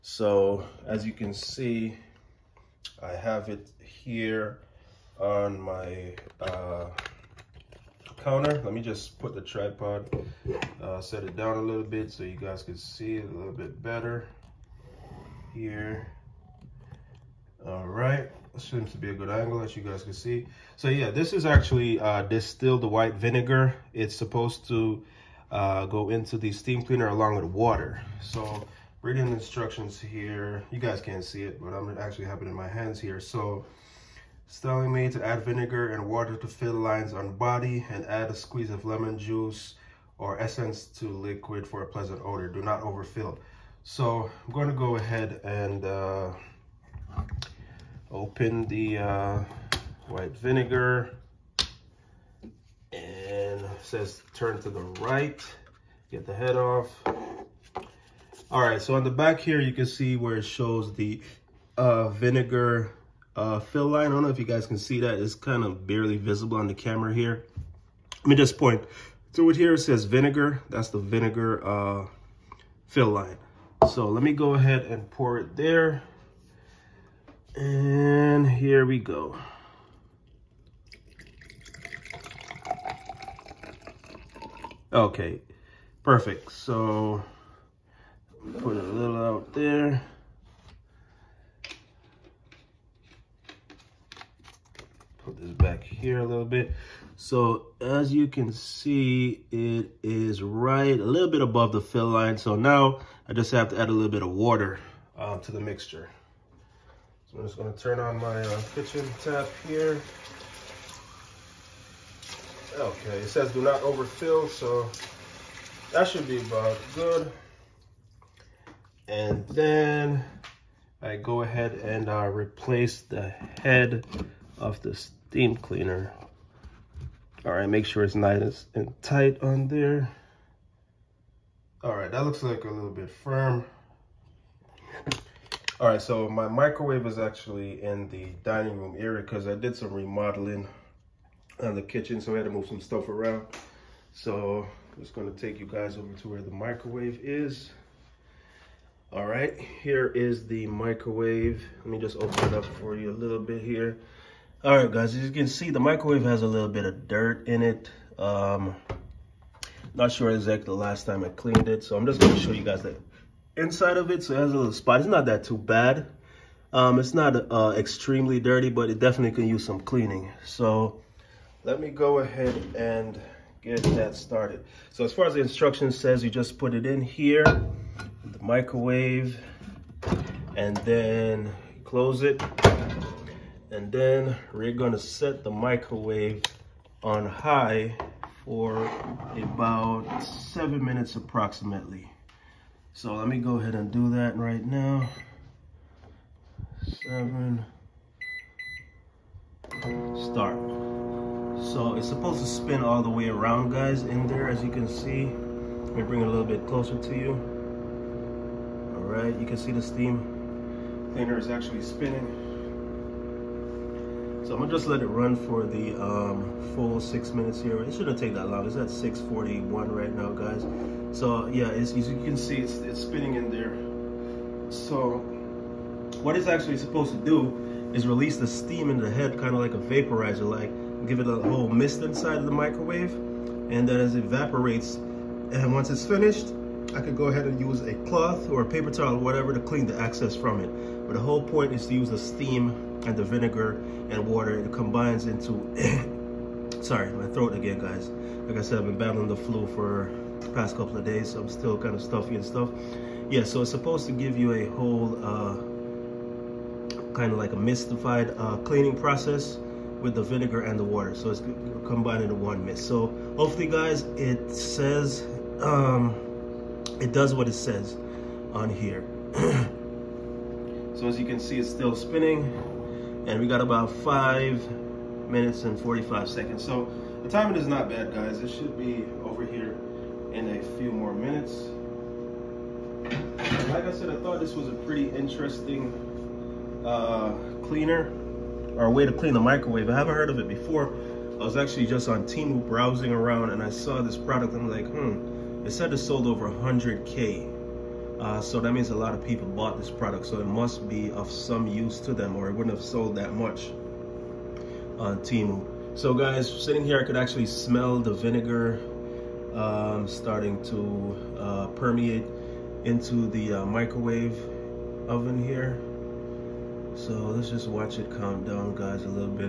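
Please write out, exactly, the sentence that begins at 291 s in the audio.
I was actually just on Temu browsing around and I saw this product.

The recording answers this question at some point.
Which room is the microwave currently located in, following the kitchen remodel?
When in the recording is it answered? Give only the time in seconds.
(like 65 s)
138 s.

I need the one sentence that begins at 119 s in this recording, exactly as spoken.
And then I go ahead and uh, replace the head of the steam cleaner.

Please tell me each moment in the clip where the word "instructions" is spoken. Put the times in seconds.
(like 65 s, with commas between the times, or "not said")
29 s, 175 s.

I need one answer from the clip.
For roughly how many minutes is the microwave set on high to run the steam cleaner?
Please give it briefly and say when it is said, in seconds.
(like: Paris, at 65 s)
7, at 190 s.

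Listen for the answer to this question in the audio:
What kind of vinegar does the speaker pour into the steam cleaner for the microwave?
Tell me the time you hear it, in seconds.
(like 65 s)
22 s.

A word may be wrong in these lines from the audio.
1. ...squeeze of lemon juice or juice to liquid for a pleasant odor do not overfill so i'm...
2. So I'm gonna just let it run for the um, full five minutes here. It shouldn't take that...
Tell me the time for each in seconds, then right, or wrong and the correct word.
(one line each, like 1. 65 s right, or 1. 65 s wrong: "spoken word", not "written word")
1. 38 s wrong: "essence", not "juice"
2. 214 s wrong: "six", not "five".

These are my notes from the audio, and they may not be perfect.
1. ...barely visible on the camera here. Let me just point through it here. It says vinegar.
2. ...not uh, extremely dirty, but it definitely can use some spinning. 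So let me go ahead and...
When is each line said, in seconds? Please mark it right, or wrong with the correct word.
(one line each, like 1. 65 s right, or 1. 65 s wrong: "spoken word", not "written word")
1. 65 s right
2. 167 s wrong: "cleaning", not "spinning".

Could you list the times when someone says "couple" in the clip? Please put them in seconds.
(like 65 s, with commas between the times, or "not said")
250 s.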